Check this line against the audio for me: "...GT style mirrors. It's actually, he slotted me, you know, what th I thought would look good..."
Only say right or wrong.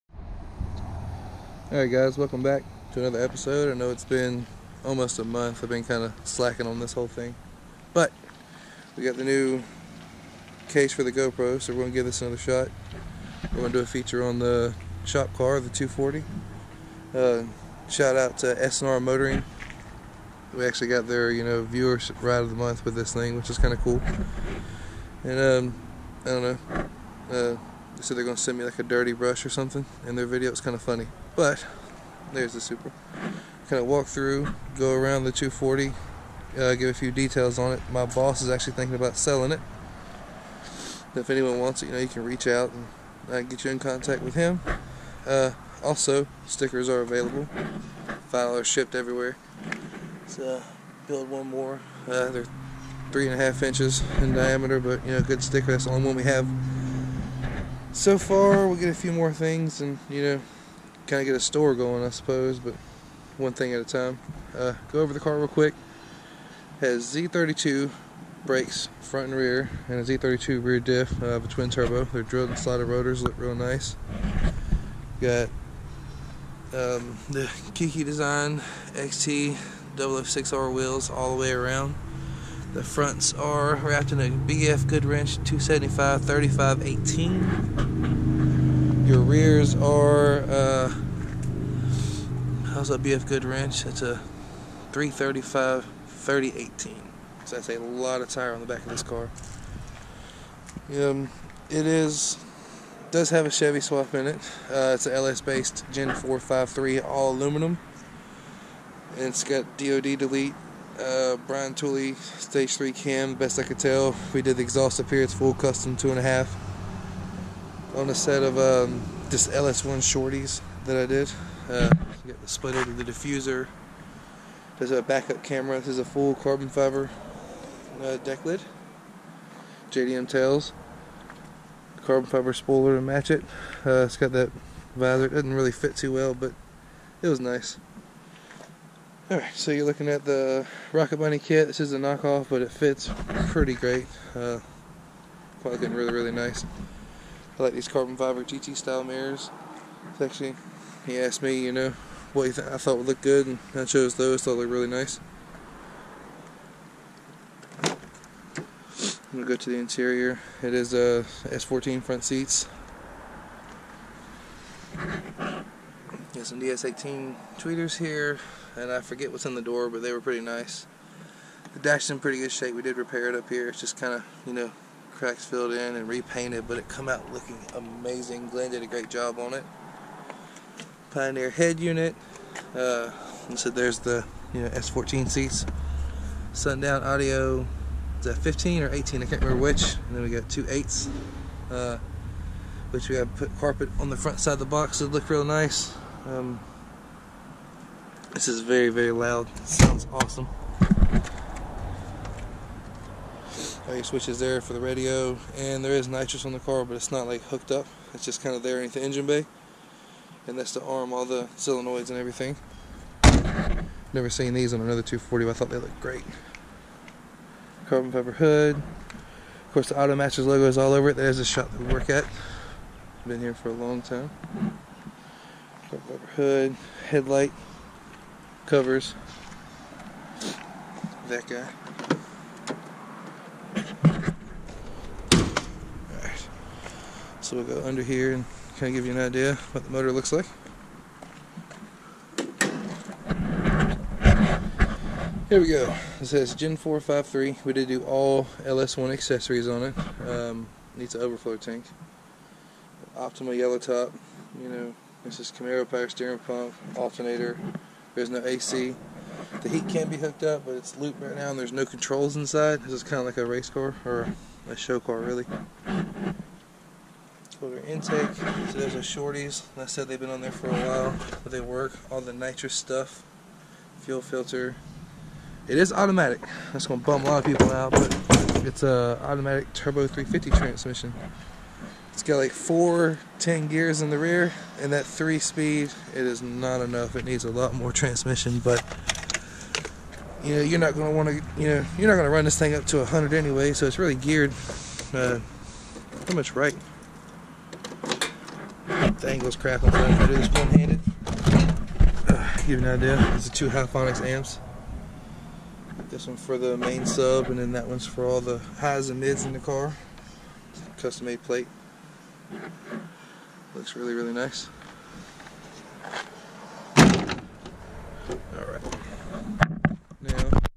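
wrong.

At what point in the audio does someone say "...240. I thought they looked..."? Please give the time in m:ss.
3:35.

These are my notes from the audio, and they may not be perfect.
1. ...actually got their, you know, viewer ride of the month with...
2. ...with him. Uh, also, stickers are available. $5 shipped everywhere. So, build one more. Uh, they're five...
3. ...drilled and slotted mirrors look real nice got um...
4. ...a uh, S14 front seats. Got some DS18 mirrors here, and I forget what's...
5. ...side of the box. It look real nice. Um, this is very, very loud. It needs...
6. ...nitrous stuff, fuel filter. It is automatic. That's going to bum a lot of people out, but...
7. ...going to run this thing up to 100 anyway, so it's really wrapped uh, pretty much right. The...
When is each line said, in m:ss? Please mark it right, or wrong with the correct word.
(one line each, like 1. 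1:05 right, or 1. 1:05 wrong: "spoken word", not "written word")
1. 0:20 right
2. 0:44 wrong: "three", not "five"
3. 1:12 wrong: "rotors", not "mirrors"
4. 2:40 wrong: "tweeters", not "mirrors"
5. 3:14 wrong: "sounds", not "needs"
6. 4:32 right
7. 4:52 wrong: "geared", not "wrapped".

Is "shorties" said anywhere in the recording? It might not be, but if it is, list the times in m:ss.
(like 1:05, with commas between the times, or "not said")
1:59, 4:28.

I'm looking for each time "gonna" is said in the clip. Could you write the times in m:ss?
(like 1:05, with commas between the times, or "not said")
0:28, 2:39.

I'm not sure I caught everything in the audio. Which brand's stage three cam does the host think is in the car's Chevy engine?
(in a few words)
Brian Tooley.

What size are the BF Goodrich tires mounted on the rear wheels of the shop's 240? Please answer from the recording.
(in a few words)
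335 30 18.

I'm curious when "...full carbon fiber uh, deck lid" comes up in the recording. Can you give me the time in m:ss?
2:06.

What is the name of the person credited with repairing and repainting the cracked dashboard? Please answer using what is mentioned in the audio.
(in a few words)
Glenn.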